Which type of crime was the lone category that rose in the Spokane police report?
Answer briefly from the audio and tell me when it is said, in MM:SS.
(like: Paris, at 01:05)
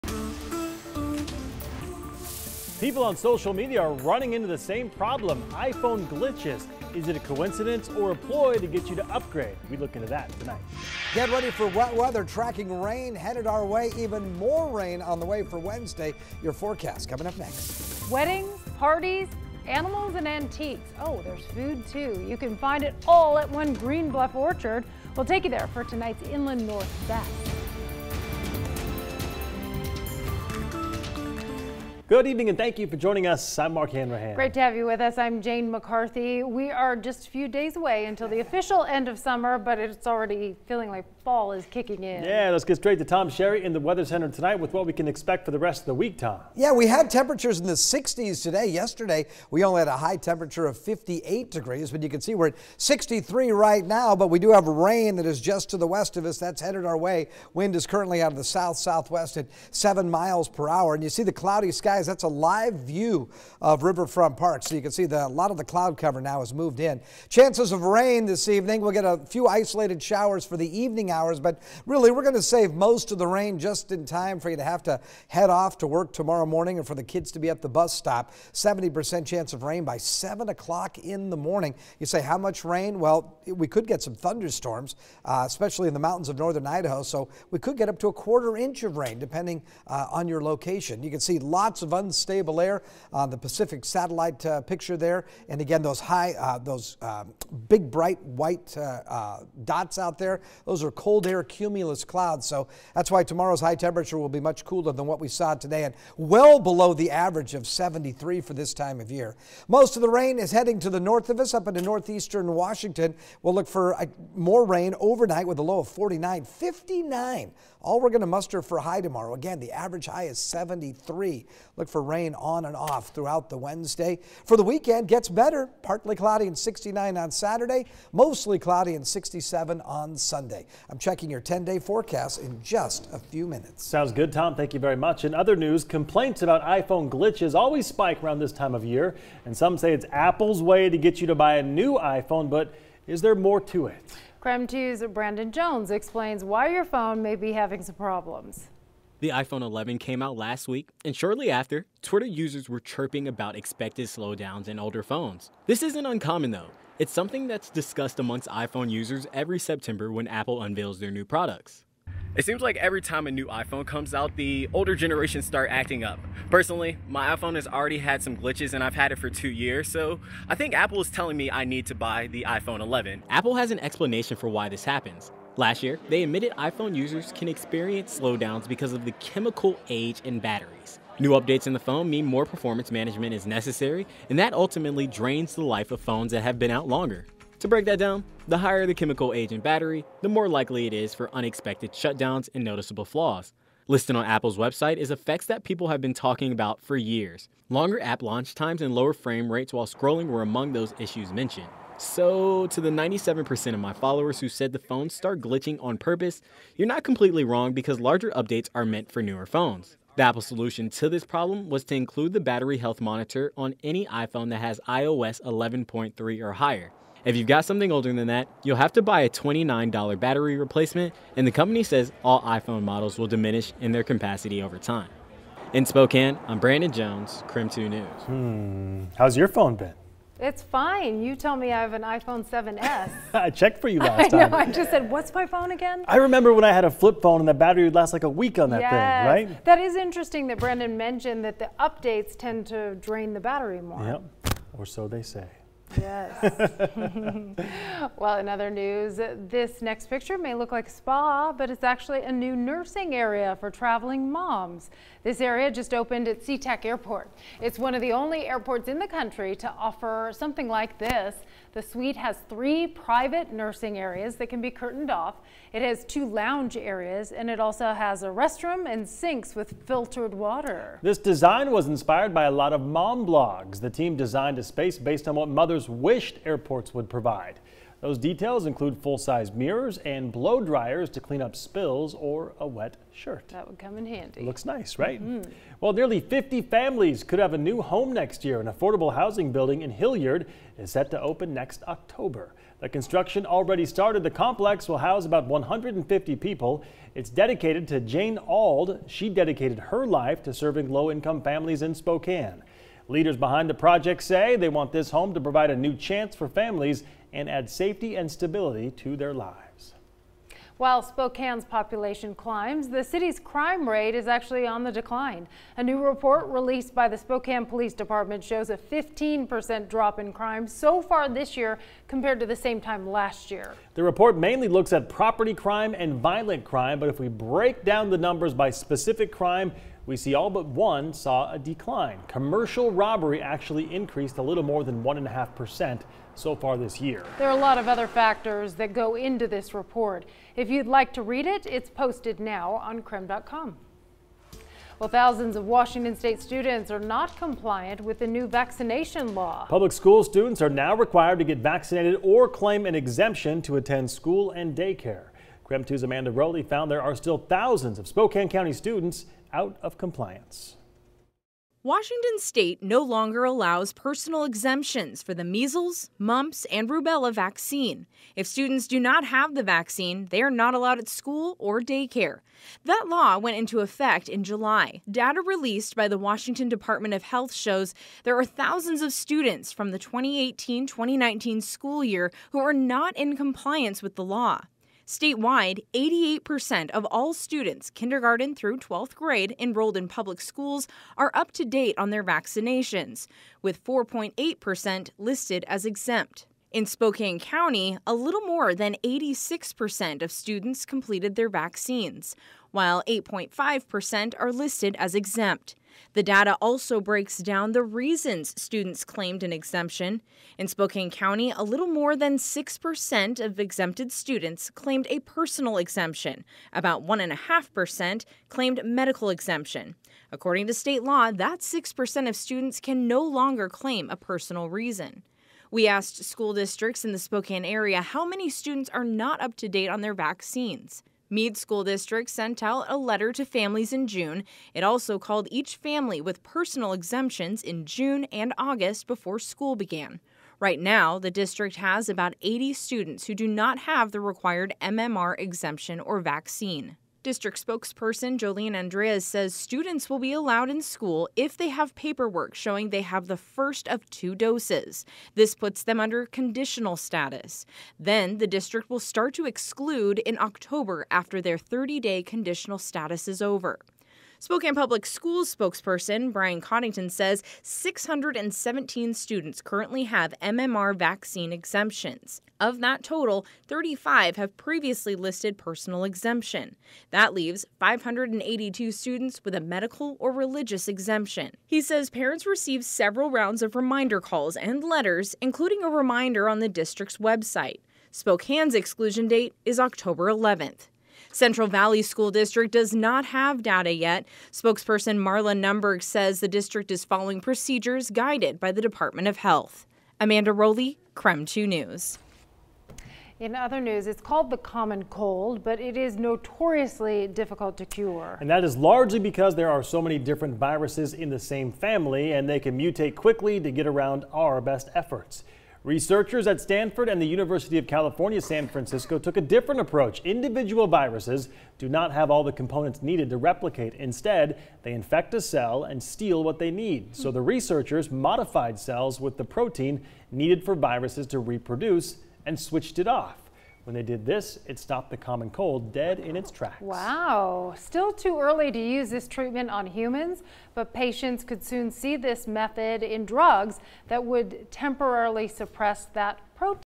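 Commercial robbery, at 05:32.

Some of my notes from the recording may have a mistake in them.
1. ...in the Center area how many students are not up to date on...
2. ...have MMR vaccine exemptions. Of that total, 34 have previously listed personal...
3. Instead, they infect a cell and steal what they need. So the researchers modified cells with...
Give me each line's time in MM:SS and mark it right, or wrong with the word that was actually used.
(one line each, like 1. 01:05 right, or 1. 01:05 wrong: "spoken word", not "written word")
1. 07:07 wrong: "Spokane", not "Center"
2. 07:50 wrong: "35", not "34"
3. 08:43 right.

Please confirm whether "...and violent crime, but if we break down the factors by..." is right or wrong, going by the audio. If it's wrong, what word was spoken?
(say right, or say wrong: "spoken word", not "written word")
wrong: "numbers", not "factors".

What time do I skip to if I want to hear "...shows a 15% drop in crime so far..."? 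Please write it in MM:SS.
05:18.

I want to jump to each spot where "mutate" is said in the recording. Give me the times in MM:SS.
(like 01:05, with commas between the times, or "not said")
08:32.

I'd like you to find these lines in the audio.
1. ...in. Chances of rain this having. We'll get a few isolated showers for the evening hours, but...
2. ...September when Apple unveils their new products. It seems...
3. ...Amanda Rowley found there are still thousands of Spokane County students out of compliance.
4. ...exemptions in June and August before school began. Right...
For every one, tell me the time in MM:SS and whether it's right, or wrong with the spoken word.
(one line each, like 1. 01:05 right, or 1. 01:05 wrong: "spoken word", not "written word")
1. 01:06 wrong: "evening", not "having"
2. 02:39 right
3. 05:56 right
4. 07:16 right.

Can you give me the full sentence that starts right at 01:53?
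We'll look for more rain overnight with a low of 49, 59.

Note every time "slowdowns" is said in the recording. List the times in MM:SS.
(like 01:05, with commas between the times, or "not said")
02:34, 02:58.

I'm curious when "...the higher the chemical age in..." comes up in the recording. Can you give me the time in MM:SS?
03:08.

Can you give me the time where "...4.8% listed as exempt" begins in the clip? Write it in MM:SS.
06:33.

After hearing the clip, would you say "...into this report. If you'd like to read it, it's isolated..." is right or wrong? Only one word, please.
wrong.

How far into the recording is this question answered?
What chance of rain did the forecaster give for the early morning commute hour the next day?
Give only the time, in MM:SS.
01:18.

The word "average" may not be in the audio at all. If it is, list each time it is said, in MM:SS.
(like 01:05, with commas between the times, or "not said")
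01:47, 01:59.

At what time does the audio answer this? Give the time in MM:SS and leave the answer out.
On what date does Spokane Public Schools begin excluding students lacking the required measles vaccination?
08:09.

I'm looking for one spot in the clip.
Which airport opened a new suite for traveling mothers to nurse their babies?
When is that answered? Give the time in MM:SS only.
04:16.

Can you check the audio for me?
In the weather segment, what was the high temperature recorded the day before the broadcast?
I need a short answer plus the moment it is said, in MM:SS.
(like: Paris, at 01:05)
58 degrees, at 00:50.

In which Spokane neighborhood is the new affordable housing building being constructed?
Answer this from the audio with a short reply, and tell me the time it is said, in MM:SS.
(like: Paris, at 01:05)
Hillyard, at 04:49.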